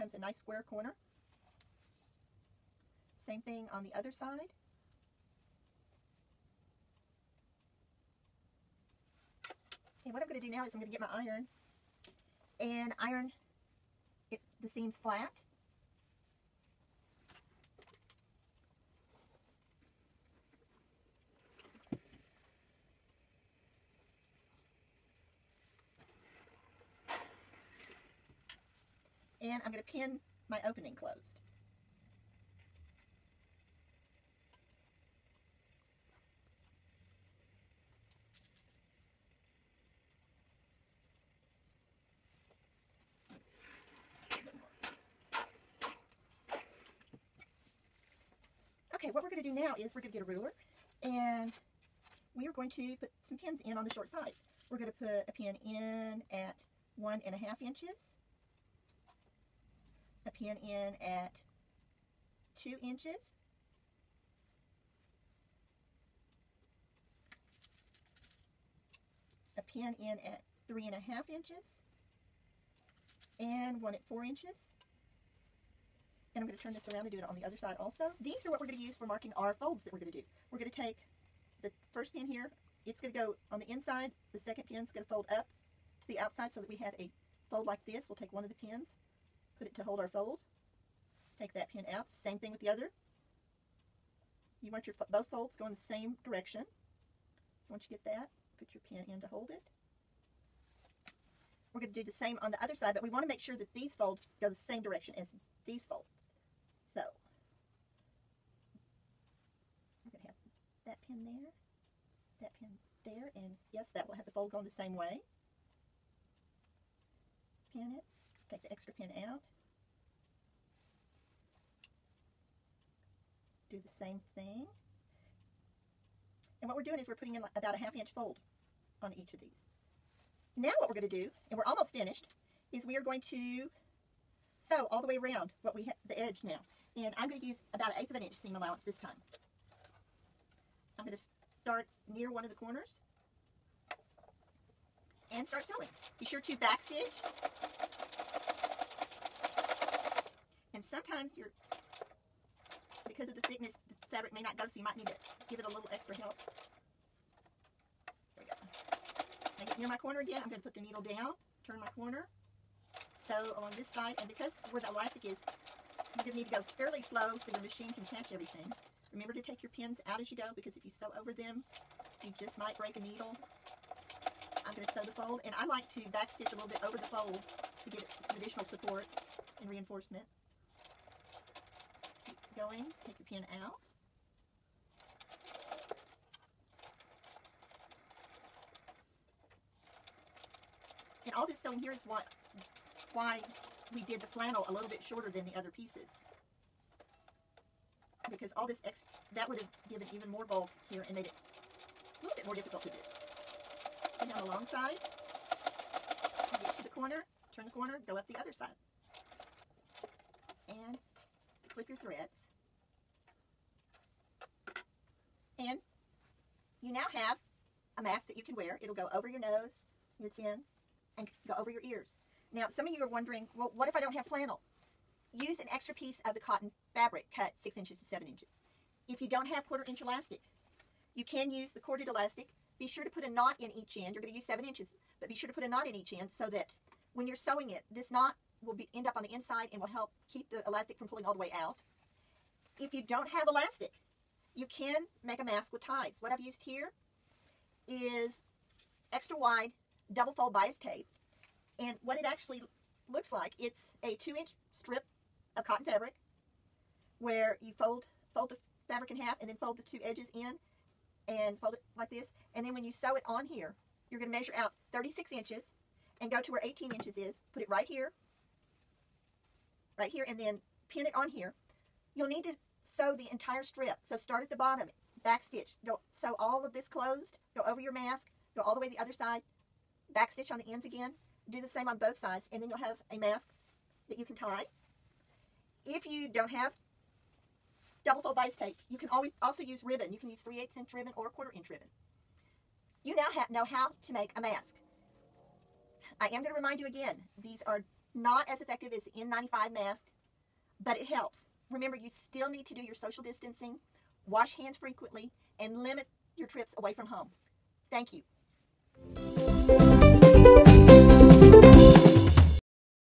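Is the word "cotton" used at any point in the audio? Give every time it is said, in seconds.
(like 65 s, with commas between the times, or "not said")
226 s, 255 s.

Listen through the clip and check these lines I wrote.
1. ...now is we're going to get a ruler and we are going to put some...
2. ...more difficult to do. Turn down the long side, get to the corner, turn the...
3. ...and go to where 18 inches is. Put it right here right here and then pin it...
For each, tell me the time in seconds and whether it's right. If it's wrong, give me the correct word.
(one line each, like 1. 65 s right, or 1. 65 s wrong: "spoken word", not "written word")
1. 49 s right
2. 202 s right
3. 266 s right.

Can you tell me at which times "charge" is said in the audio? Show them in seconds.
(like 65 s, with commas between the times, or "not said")
not said.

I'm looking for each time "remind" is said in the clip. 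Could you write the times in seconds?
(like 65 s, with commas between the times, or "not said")
296 s.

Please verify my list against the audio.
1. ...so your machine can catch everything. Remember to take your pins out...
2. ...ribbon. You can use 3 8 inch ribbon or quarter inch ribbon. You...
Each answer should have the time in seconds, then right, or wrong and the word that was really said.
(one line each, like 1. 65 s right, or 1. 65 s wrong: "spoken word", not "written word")
1. 167 s right
2. 289 s right.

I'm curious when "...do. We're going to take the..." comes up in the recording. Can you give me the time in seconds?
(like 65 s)
80 s.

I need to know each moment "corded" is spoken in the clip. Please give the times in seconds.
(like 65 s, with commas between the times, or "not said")
231 s.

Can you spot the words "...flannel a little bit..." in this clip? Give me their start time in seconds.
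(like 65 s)
194 s.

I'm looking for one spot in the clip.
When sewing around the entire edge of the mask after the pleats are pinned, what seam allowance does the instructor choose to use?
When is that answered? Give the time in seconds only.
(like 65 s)
137 s.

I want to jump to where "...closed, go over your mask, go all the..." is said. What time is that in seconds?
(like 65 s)
276 s.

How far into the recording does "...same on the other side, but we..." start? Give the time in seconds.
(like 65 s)
102 s.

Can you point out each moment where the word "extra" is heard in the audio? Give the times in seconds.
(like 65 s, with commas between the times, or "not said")
118 s, 155 s, 198 s, 225 s, 249 s.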